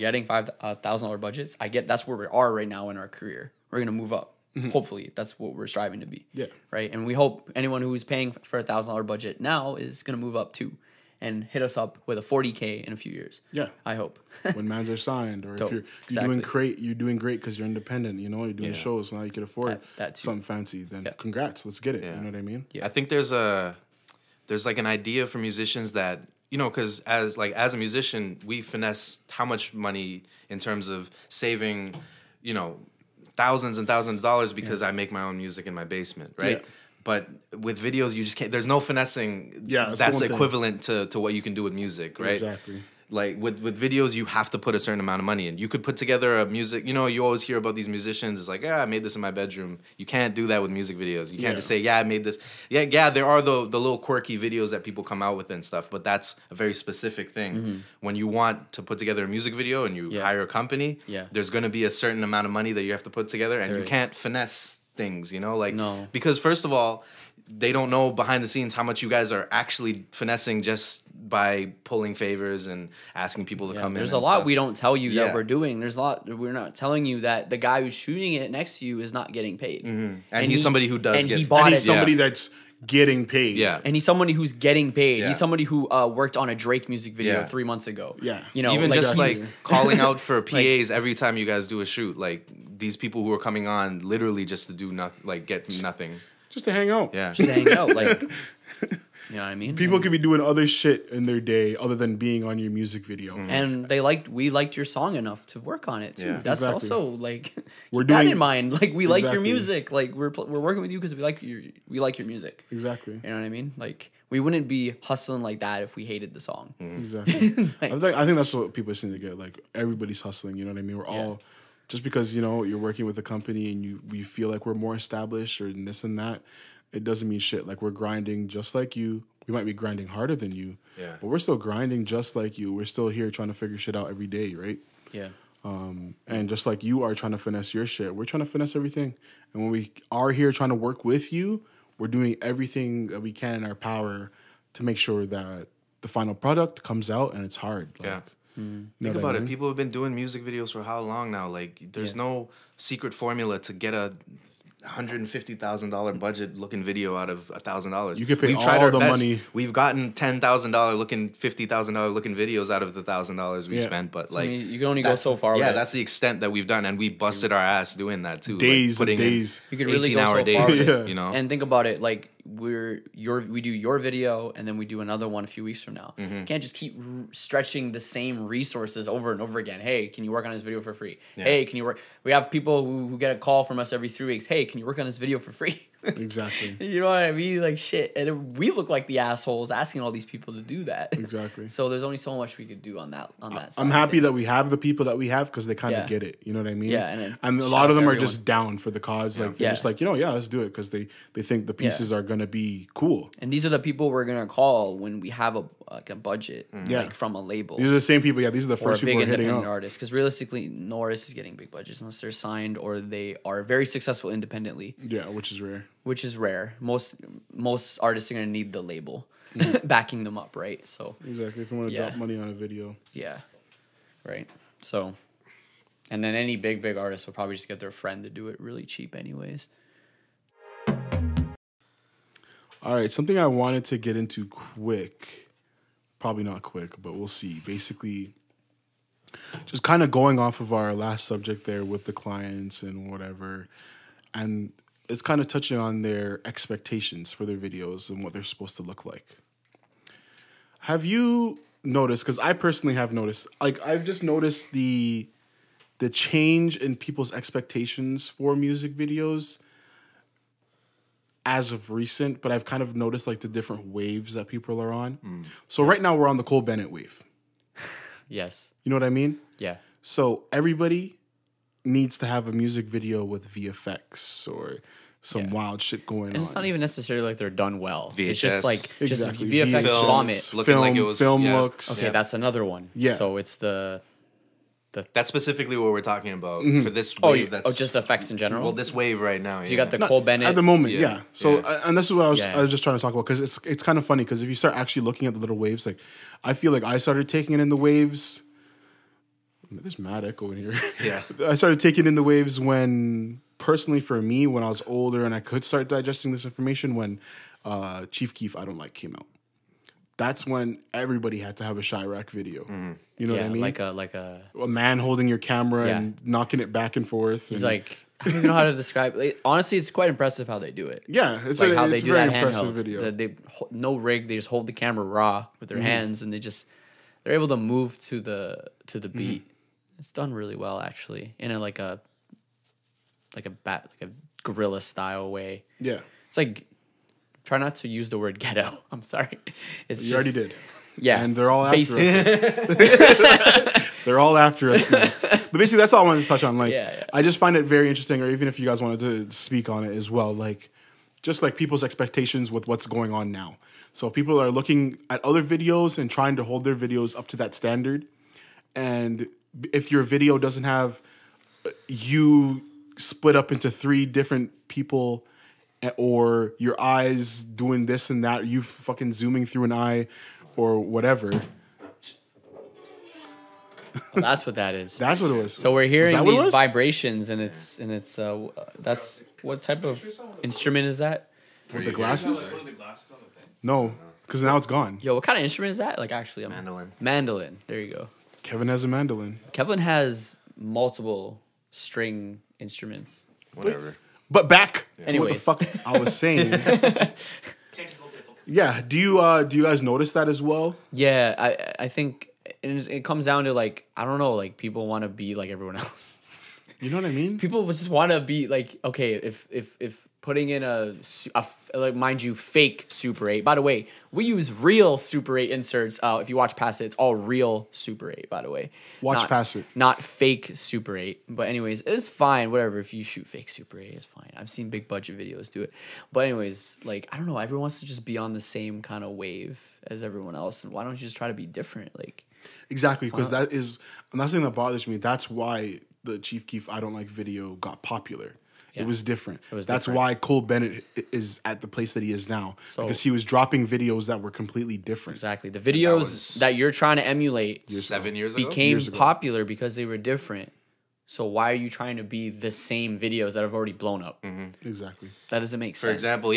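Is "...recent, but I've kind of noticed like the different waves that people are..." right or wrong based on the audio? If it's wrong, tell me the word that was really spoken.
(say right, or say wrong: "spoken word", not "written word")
right.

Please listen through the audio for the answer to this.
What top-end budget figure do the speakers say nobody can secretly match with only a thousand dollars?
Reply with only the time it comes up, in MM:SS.
02:33.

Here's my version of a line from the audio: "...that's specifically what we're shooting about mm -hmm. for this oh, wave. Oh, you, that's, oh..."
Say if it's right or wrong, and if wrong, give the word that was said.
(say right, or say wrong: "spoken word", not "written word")
wrong: "talking", not "shooting".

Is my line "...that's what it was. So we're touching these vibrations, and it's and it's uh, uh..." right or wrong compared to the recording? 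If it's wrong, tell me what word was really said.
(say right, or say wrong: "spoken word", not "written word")
wrong: "hearing", not "touching".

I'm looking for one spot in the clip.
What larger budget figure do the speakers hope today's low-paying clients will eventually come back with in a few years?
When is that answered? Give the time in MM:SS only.
00:12.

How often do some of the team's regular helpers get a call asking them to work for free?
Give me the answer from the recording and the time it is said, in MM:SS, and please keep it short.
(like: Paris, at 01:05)
Every 3 weeks, at 03:03.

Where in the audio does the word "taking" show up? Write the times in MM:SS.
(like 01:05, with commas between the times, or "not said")
04:57, 05:01.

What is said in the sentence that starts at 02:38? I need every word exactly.
You could pay we've all tried the best.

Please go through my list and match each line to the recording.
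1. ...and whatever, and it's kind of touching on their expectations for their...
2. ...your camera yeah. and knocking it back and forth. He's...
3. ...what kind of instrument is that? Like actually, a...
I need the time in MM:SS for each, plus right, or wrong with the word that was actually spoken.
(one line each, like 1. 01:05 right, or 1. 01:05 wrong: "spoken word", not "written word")
1. 04:02 right
2. 05:15 right
3. 06:25 right.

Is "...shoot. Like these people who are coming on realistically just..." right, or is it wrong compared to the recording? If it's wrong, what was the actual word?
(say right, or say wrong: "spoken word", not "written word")
wrong: "literally", not "realistically".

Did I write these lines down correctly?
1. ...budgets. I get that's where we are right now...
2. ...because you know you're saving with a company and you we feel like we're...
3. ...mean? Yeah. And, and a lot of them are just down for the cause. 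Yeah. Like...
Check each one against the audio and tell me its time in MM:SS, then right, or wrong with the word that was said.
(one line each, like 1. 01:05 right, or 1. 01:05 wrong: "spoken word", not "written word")
1. 00:01 right
2. 02:02 wrong: "working", not "saving"
3. 03:16 right.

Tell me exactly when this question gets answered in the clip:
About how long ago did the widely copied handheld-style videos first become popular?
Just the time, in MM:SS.
07:27.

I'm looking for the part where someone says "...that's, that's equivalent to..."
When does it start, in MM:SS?
00:39.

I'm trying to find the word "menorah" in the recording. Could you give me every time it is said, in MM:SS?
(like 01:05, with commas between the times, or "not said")
not said.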